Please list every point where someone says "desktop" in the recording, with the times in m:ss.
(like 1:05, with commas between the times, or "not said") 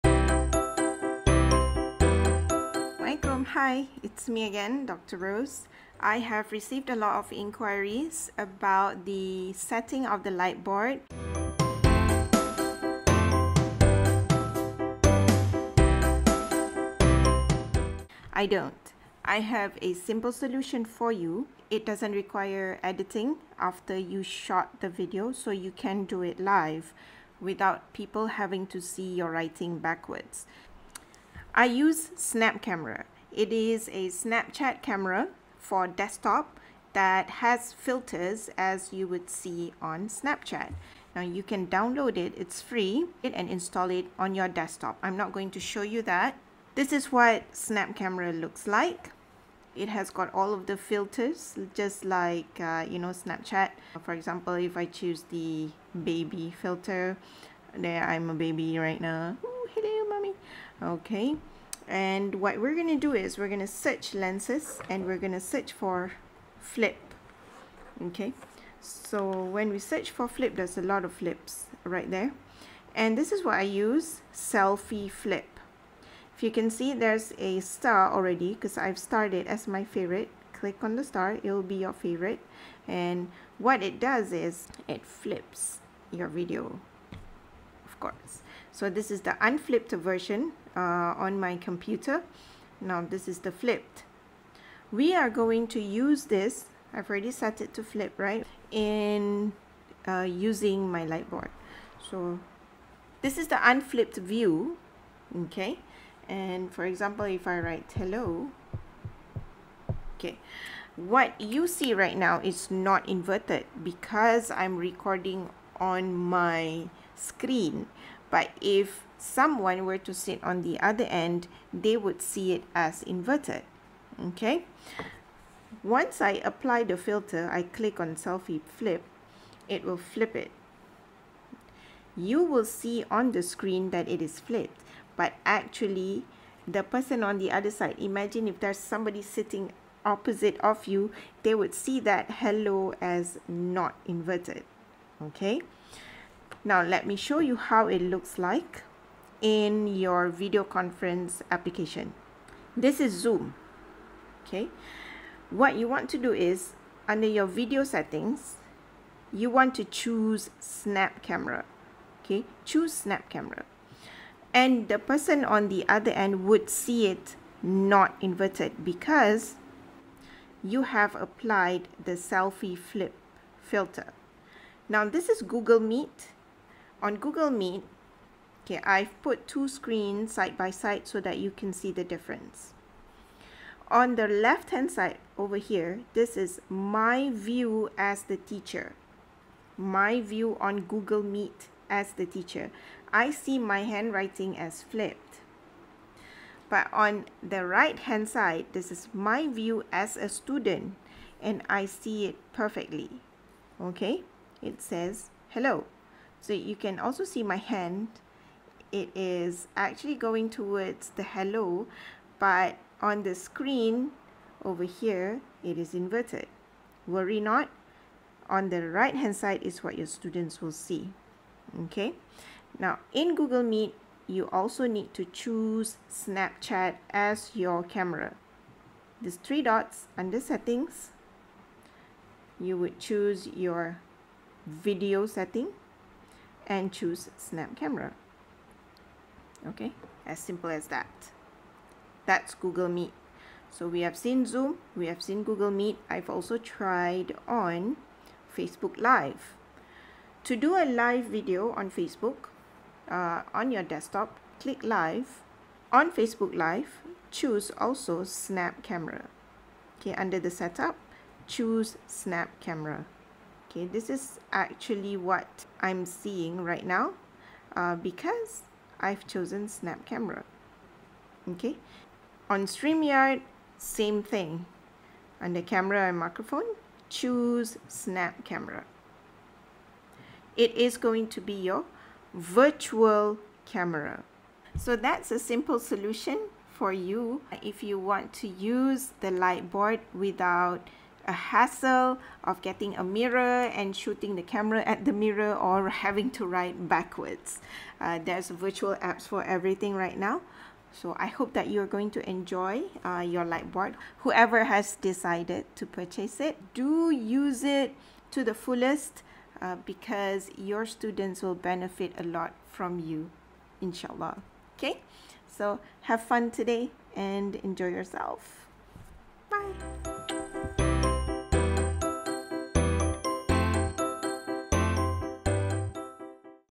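0:35, 0:44, 4:13.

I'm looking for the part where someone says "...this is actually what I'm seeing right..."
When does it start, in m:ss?
4:23.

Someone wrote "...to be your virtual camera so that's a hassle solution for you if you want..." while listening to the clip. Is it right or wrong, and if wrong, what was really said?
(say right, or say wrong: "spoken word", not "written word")
wrong: "simple", not "hassle".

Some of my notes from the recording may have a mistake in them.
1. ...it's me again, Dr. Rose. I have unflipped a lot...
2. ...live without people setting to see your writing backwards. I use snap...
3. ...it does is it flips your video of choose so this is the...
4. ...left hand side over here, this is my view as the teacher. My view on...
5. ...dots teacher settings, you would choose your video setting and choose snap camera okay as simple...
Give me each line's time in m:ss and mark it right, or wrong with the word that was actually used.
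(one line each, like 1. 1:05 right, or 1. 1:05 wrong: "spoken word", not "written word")
1. 0:04 wrong: "received", not "unflipped"
2. 0:26 wrong: "having", not "setting"
3. 1:23 wrong: "course", not "choose"
4. 3:04 right
5. 3:49 wrong: "under", not "teacher".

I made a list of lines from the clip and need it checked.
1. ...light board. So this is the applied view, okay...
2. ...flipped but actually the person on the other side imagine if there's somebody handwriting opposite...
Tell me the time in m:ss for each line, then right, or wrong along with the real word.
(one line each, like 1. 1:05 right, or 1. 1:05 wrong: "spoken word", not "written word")
1. 1:41 wrong: "unflipped", not "applied"
2. 2:14 wrong: "sitting", not "handwriting".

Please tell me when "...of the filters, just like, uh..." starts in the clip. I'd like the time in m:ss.
0:50.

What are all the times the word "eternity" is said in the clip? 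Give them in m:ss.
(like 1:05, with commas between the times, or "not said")
not said.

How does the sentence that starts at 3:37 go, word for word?
Worry not, on the right hand side is what your students will see.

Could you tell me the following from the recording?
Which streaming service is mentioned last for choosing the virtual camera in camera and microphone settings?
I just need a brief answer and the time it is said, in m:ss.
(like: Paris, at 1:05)
StreamYard, at 4:32.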